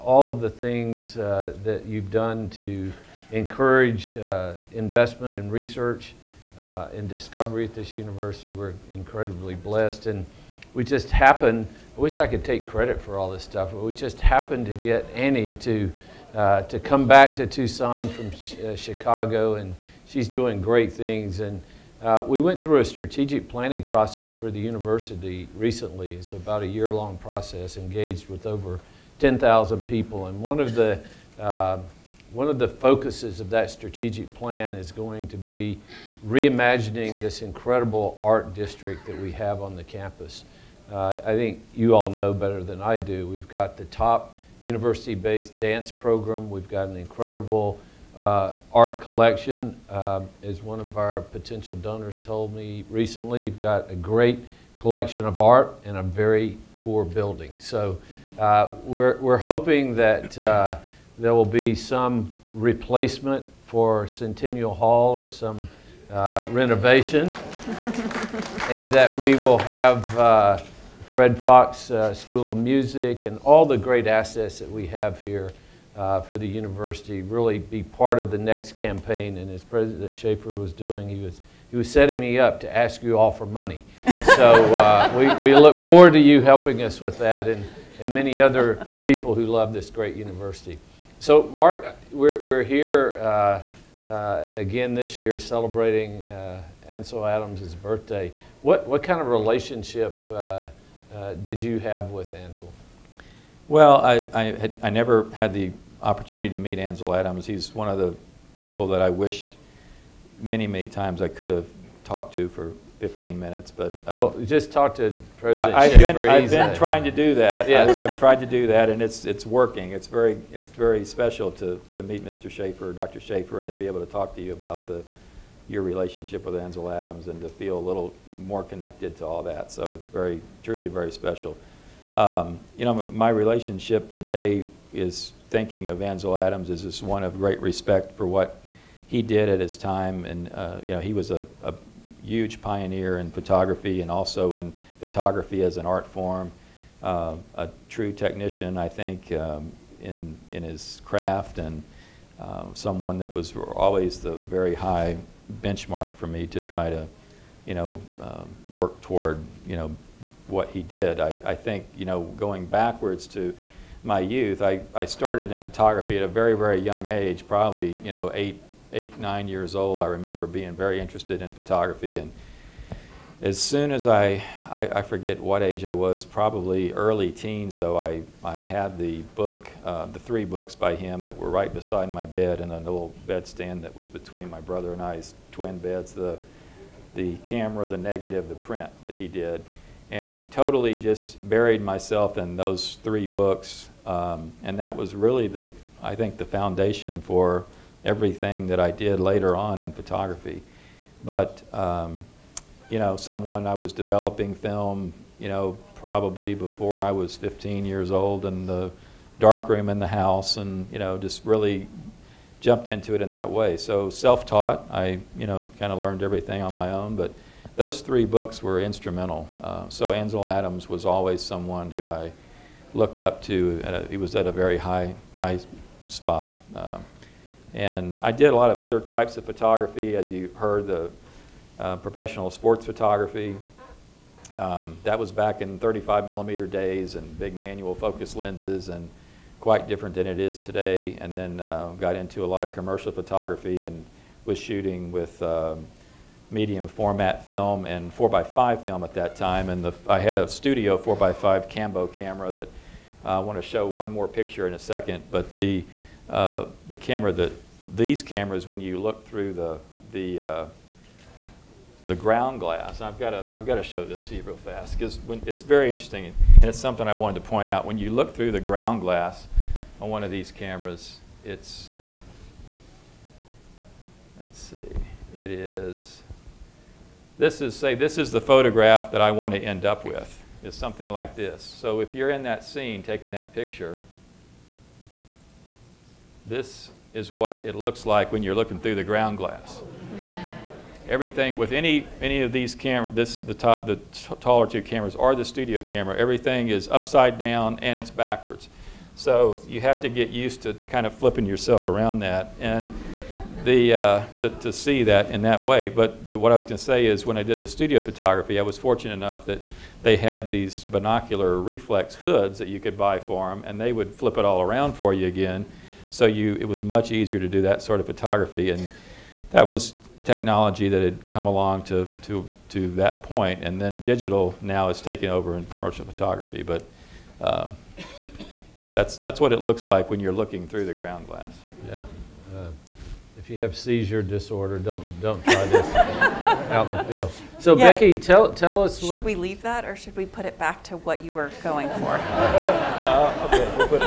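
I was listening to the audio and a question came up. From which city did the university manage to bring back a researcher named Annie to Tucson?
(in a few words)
Chicago.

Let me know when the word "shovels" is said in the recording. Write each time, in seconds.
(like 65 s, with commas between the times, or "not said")
not said.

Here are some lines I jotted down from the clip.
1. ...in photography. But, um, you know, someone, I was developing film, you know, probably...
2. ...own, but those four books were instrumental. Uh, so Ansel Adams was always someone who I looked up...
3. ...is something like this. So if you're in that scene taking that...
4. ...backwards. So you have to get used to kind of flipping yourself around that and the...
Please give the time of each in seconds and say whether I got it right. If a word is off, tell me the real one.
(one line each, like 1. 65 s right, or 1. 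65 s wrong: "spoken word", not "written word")
1. 199 s right
2. 216 s wrong: "three", not "four"
3. 280 s right
4. 298 s right.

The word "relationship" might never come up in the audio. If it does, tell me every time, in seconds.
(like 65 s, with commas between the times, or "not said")
99 s, 125 s, 133 s.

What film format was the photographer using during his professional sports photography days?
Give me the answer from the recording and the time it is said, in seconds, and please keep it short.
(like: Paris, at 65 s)
35 millimeter, at 235 s.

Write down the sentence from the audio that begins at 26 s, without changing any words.
It's about a year long process, engaged with over 10,000 people.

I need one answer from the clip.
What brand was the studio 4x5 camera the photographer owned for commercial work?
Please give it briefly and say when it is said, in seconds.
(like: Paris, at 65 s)
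Cambo, at 251 s.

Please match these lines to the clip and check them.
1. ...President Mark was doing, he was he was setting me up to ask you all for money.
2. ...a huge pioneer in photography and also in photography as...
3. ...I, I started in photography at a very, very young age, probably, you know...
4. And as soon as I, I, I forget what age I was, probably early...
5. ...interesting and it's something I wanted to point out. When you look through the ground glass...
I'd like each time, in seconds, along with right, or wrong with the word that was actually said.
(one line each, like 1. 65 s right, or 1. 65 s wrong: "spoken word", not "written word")
1. 79 s wrong: "Schaefer", not "Mark"
2. 141 s right
3. 164 s right
4. 172 s right
5. 265 s right.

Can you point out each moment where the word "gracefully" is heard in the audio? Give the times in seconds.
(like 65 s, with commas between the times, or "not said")
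not said.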